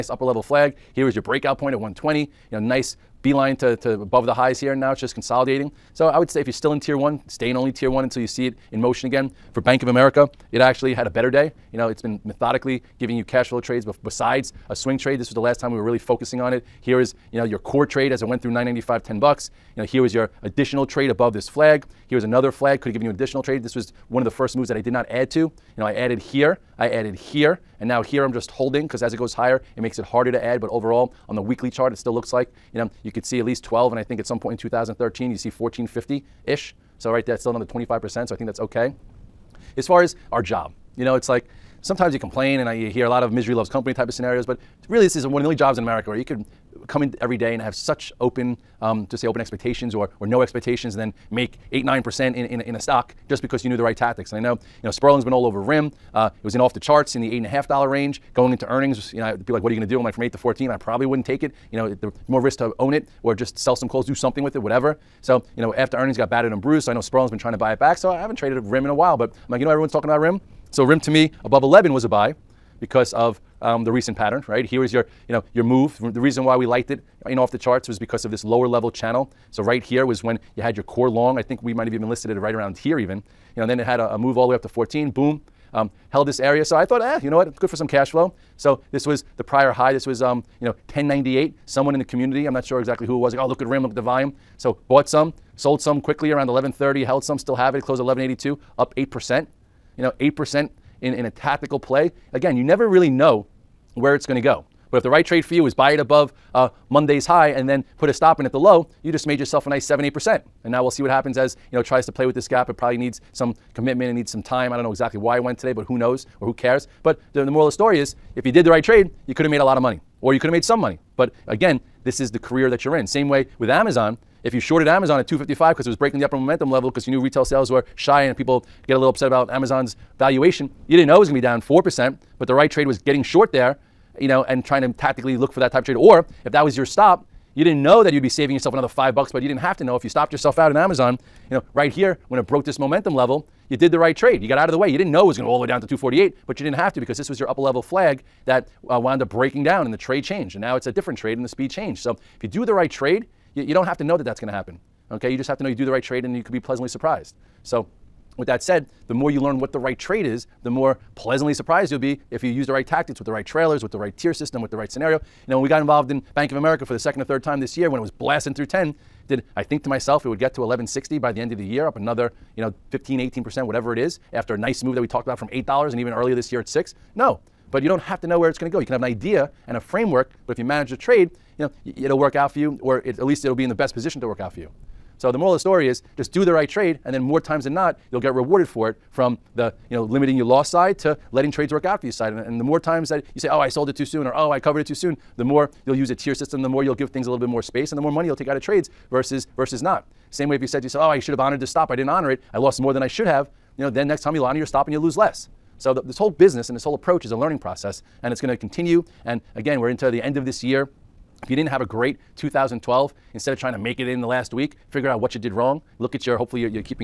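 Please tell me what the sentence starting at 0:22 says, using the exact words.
Here's another flag, could have given you an additional trade.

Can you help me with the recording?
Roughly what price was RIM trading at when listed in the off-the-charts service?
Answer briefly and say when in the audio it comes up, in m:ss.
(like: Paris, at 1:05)
8.50, at 0:57.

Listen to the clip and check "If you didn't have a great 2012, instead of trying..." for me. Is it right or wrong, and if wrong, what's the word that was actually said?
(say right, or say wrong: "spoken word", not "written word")
right.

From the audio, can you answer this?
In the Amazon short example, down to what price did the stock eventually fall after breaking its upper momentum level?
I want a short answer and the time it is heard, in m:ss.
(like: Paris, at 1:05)
248, at 2:25.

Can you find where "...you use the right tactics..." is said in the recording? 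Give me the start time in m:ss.
2:42.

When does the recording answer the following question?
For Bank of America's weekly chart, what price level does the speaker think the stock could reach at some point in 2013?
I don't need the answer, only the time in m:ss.
0:35.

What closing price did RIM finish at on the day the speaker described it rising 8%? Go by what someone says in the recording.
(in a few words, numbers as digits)
11.82.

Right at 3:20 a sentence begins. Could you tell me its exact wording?
Same way if you said to yourself, oh, I should have honored the stop.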